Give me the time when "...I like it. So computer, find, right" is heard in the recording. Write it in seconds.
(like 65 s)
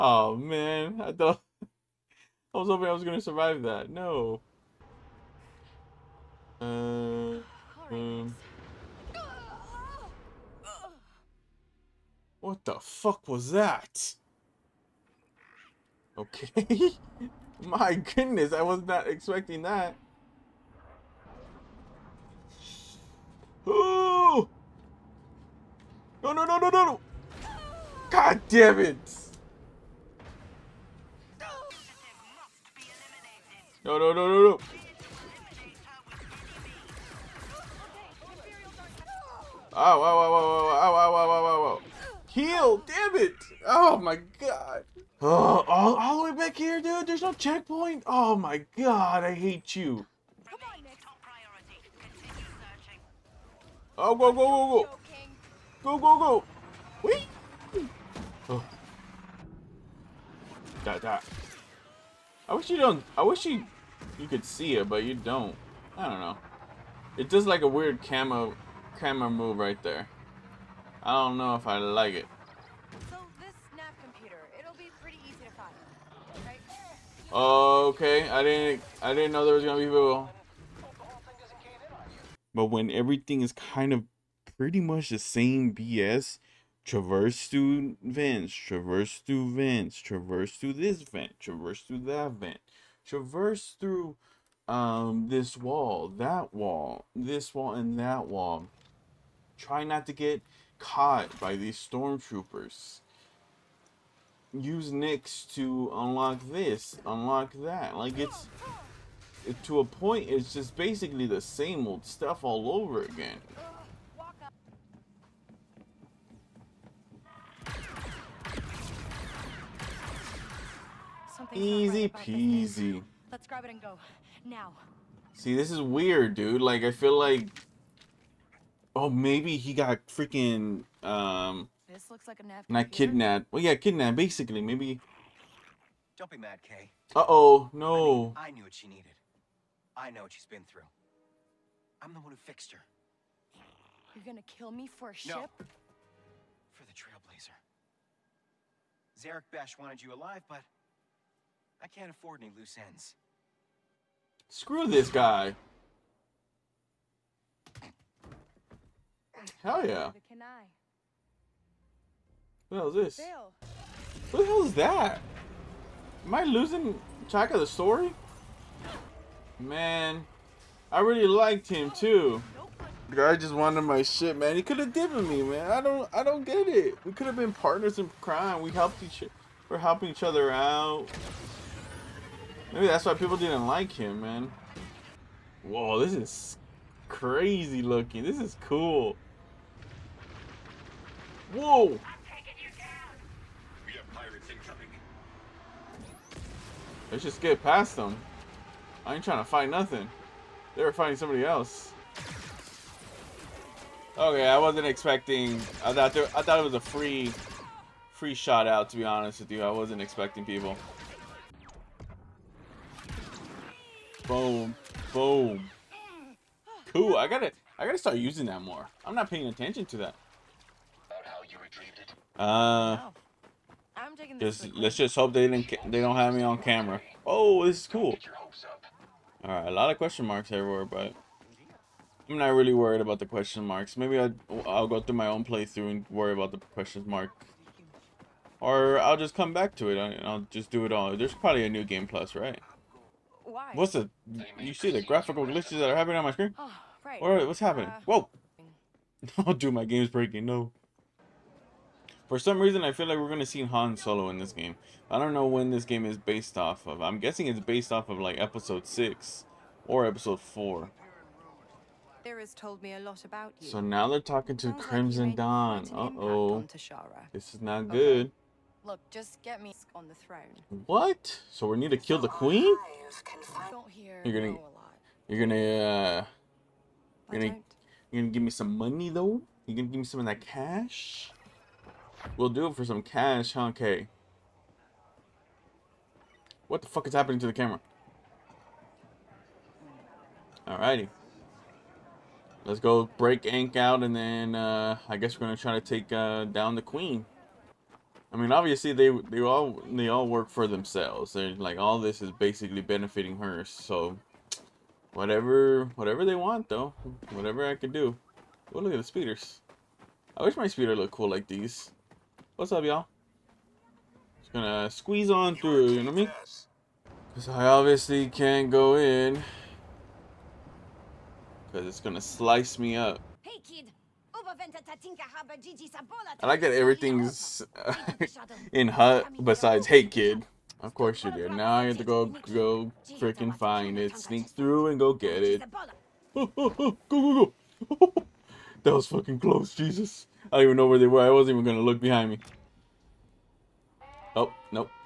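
71 s.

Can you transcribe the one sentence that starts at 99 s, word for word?
Try not to get caught by these stormtroopers.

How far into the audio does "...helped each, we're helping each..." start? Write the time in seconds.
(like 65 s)
178 s.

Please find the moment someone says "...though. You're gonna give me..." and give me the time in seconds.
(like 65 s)
279 s.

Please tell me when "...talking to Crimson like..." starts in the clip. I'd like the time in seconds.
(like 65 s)
264 s.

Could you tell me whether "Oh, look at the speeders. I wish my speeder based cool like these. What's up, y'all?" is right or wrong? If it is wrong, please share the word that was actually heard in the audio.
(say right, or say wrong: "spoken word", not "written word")
wrong: "looked", not "based".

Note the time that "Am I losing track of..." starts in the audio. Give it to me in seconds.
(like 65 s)
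166 s.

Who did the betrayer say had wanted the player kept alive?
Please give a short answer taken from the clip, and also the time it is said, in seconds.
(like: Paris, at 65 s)
Zerek Besh, at 149 s.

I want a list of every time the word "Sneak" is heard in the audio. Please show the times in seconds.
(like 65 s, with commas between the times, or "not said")
334 s.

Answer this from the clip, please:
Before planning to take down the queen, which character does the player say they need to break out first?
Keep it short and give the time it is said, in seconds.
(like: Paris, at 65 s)
Ank, at 293 s.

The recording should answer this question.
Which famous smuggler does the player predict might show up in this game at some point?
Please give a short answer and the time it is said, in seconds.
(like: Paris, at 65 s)
Han Solo, at 253 s.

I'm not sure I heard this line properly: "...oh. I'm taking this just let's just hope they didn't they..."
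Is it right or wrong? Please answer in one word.
right.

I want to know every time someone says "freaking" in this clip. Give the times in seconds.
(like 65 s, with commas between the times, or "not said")
130 s, 333 s.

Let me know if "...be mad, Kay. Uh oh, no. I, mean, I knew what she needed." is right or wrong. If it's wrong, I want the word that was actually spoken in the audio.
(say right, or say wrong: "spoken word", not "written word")
right.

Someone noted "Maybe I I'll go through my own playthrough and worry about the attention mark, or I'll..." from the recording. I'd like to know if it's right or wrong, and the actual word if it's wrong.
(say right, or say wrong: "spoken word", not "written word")
wrong: "question", not "attention".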